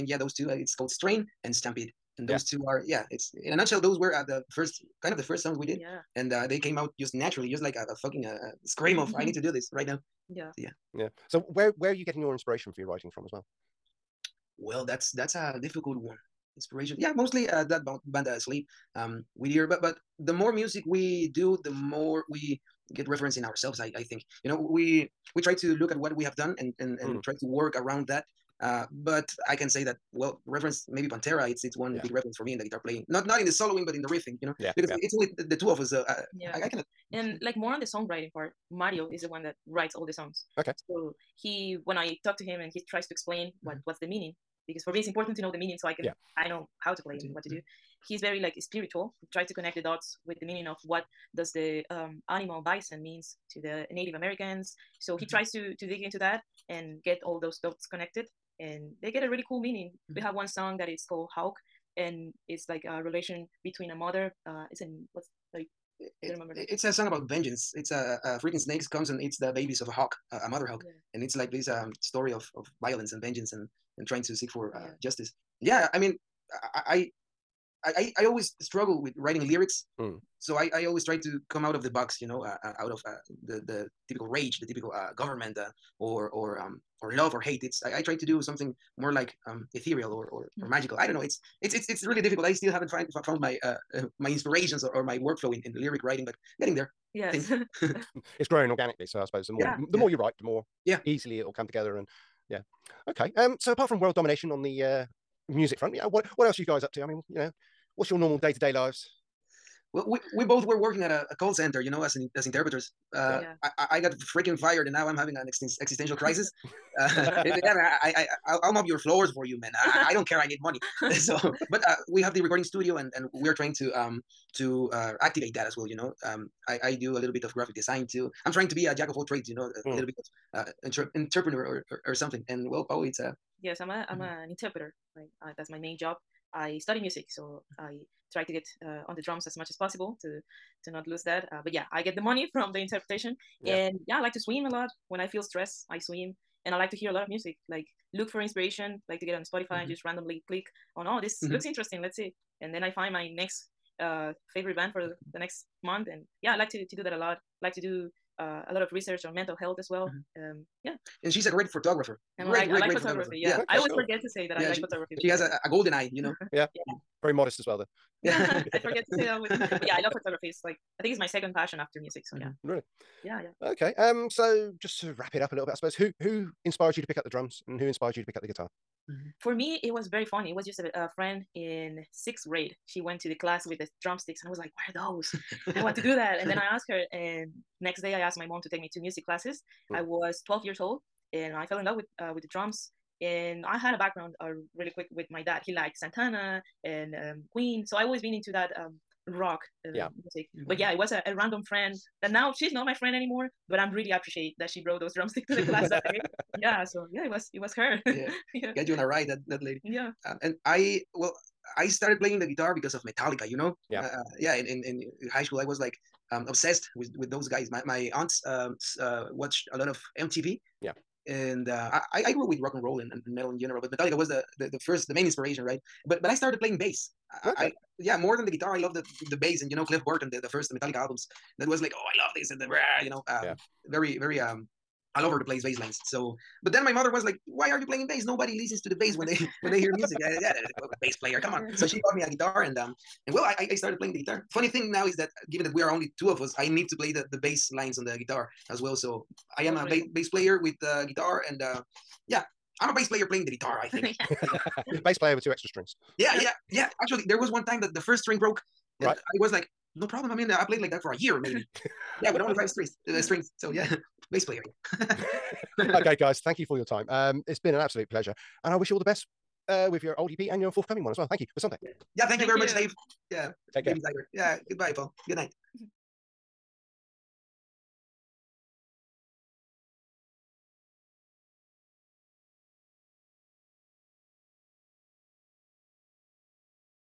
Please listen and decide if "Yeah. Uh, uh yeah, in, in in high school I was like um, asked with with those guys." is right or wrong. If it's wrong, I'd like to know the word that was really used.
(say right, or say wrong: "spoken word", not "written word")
wrong: "obsessed", not "asked".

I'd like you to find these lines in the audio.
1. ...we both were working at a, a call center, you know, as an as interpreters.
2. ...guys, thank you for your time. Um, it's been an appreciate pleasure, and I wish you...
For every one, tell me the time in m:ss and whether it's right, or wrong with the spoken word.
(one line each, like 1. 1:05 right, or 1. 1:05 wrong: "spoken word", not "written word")
1. 1:50 right
2. 4:26 wrong: "absolute", not "appreciate".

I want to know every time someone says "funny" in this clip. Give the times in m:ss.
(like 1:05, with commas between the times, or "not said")
3:00, 4:04.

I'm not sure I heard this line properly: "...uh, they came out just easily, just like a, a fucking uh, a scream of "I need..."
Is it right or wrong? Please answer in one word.
wrong.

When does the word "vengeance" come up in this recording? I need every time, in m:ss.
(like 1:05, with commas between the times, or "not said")
1:07, 1:13.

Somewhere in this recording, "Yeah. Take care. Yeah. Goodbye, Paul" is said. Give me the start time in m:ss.
4:33.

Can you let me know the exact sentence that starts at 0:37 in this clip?
And like more on the songwriting part, Mario is the one that writes all the songs.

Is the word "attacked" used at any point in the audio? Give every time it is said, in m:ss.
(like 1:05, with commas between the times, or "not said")
not said.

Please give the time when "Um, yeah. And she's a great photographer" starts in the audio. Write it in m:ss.
2:40.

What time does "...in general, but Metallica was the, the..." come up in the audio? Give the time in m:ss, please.
3:43.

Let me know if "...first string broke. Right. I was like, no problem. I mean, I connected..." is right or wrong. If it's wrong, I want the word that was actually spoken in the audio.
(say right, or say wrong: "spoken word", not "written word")
wrong: "played", not "connected".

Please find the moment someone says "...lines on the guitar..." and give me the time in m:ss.
4:07.